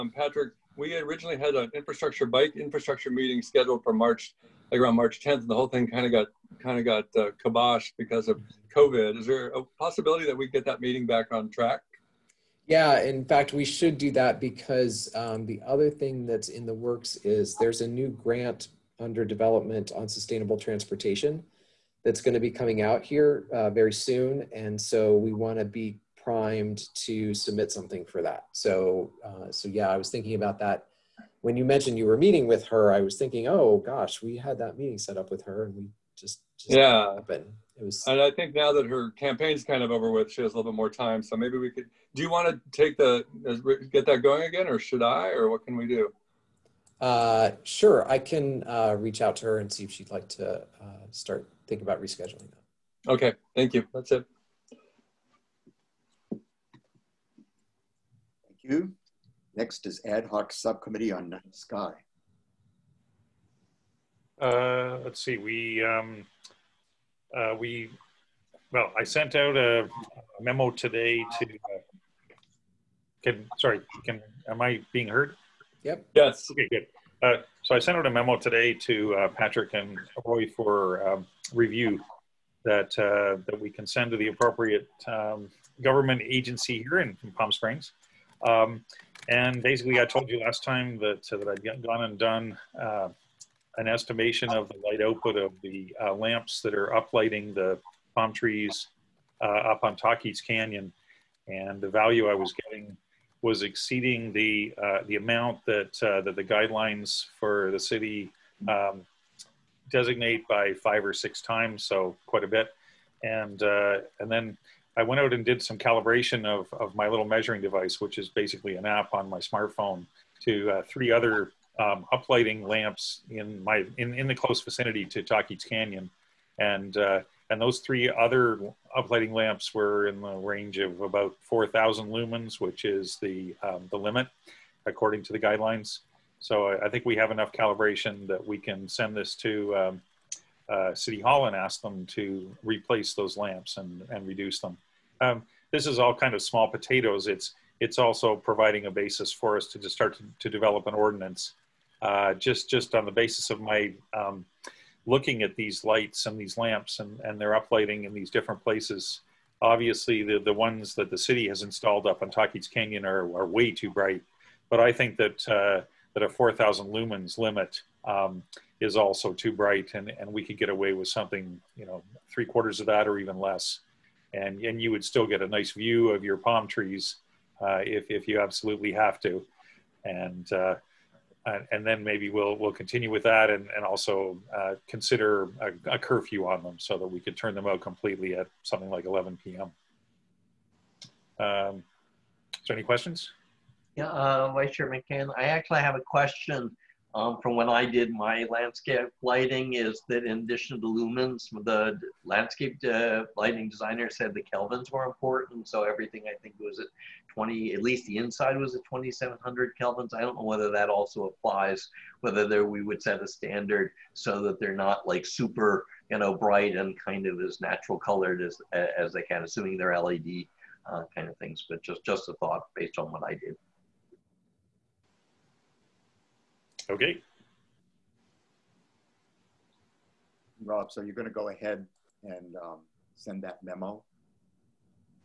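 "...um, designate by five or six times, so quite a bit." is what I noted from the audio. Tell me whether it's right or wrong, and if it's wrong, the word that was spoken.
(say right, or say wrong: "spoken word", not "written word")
right.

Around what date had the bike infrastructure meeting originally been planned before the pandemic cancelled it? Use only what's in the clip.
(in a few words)
March 10th.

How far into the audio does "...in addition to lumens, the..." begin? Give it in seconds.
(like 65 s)
200 s.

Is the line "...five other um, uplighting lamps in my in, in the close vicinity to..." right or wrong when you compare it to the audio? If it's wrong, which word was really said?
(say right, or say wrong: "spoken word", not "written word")
wrong: "three", not "five".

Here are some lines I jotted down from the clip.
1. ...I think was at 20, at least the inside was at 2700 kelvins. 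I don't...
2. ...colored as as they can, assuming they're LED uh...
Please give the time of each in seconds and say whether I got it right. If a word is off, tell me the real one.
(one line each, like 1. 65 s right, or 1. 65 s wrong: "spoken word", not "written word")
1. 206 s right
2. 217 s right.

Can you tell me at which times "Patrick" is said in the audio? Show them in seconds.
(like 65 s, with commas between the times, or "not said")
0 s, 79 s.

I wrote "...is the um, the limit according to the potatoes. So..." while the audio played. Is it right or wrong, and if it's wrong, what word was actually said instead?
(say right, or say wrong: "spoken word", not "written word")
wrong: "guidelines", not "potatoes".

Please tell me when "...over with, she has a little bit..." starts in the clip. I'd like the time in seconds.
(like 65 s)
39 s.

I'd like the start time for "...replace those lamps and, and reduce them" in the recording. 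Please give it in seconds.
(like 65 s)
142 s.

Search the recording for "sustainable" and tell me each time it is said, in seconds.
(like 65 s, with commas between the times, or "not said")
20 s.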